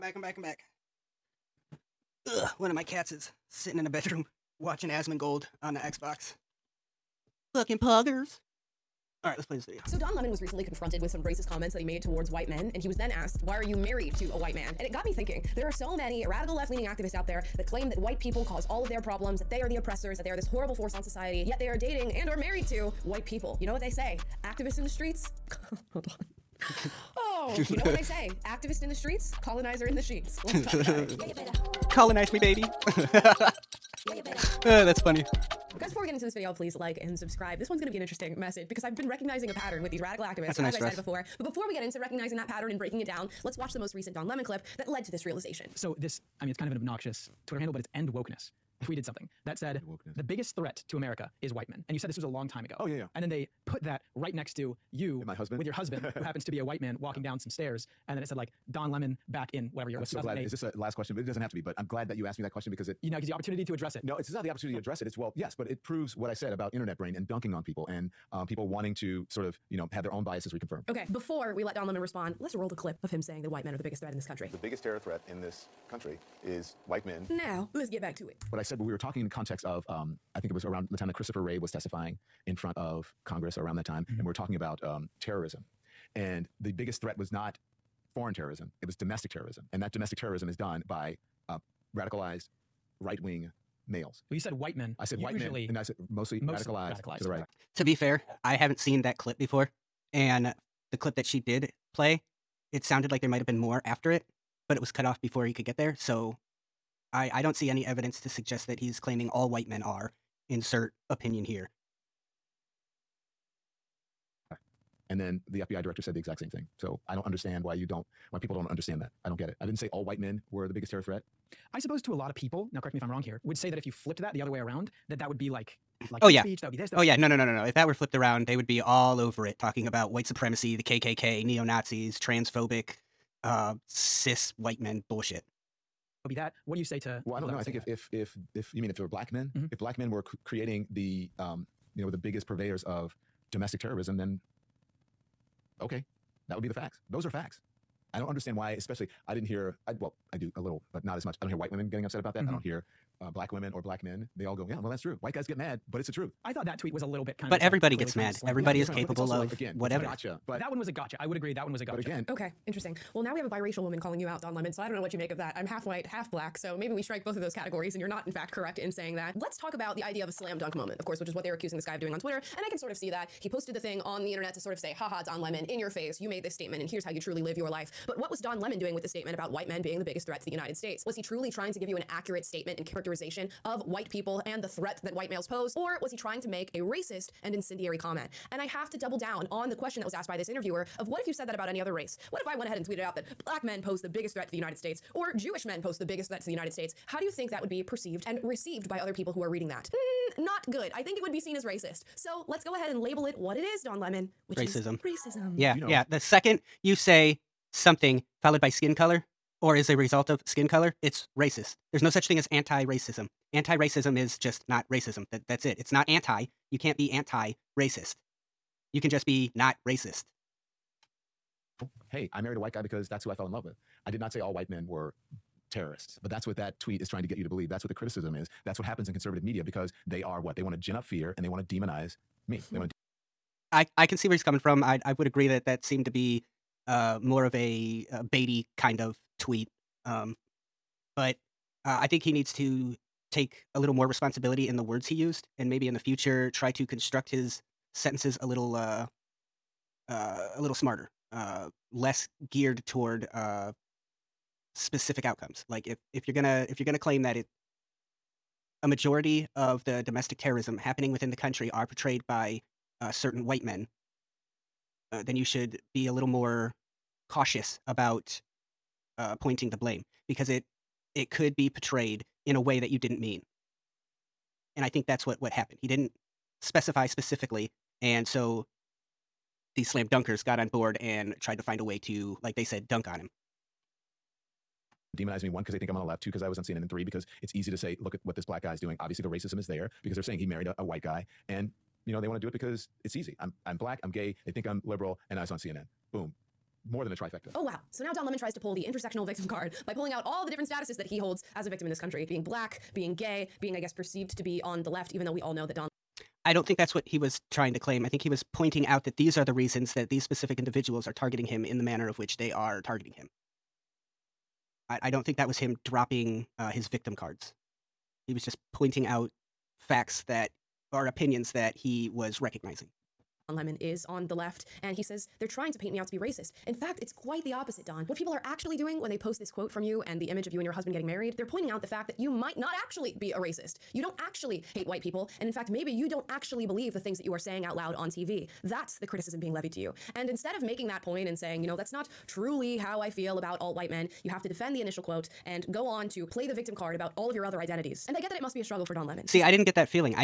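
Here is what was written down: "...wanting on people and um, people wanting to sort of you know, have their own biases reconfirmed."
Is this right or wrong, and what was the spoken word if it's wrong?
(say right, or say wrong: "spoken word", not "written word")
wrong: "dunking", not "wanting".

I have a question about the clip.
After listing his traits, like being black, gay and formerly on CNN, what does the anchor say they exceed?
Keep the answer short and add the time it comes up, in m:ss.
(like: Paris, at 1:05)
a trifecta, at 4:57.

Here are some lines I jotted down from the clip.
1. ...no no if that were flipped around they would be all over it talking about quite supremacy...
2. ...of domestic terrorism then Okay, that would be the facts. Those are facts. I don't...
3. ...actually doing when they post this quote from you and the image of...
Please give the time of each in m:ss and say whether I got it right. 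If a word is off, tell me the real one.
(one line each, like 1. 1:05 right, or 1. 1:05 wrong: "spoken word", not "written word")
1. 2:07 wrong: "white", not "quite"
2. 2:22 right
3. 5:28 right.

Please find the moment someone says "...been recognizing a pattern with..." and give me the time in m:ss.
0:38.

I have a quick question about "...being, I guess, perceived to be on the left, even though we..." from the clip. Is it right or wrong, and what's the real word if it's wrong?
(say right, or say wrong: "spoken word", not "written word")
right.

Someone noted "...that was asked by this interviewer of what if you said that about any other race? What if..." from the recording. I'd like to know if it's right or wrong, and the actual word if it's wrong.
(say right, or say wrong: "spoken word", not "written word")
right.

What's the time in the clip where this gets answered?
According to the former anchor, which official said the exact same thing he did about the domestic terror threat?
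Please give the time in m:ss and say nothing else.
1:55.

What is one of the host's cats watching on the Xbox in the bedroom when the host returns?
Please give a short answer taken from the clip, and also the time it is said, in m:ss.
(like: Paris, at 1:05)
Asmongold, at 0:04.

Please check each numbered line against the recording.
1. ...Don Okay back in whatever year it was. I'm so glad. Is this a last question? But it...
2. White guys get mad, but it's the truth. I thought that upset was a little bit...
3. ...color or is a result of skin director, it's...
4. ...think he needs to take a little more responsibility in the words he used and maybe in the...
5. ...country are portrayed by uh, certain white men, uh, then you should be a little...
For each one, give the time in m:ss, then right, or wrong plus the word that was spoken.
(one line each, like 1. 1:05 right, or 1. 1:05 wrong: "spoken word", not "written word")
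1. 0:58 wrong: "Lemon", not "Okay"
2. 2:35 wrong: "tweet", not "upset"
3. 3:28 wrong: "color", not "director"
4. 4:02 right
5. 4:21 right.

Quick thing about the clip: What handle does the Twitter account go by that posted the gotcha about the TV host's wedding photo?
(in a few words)
End Wokeness.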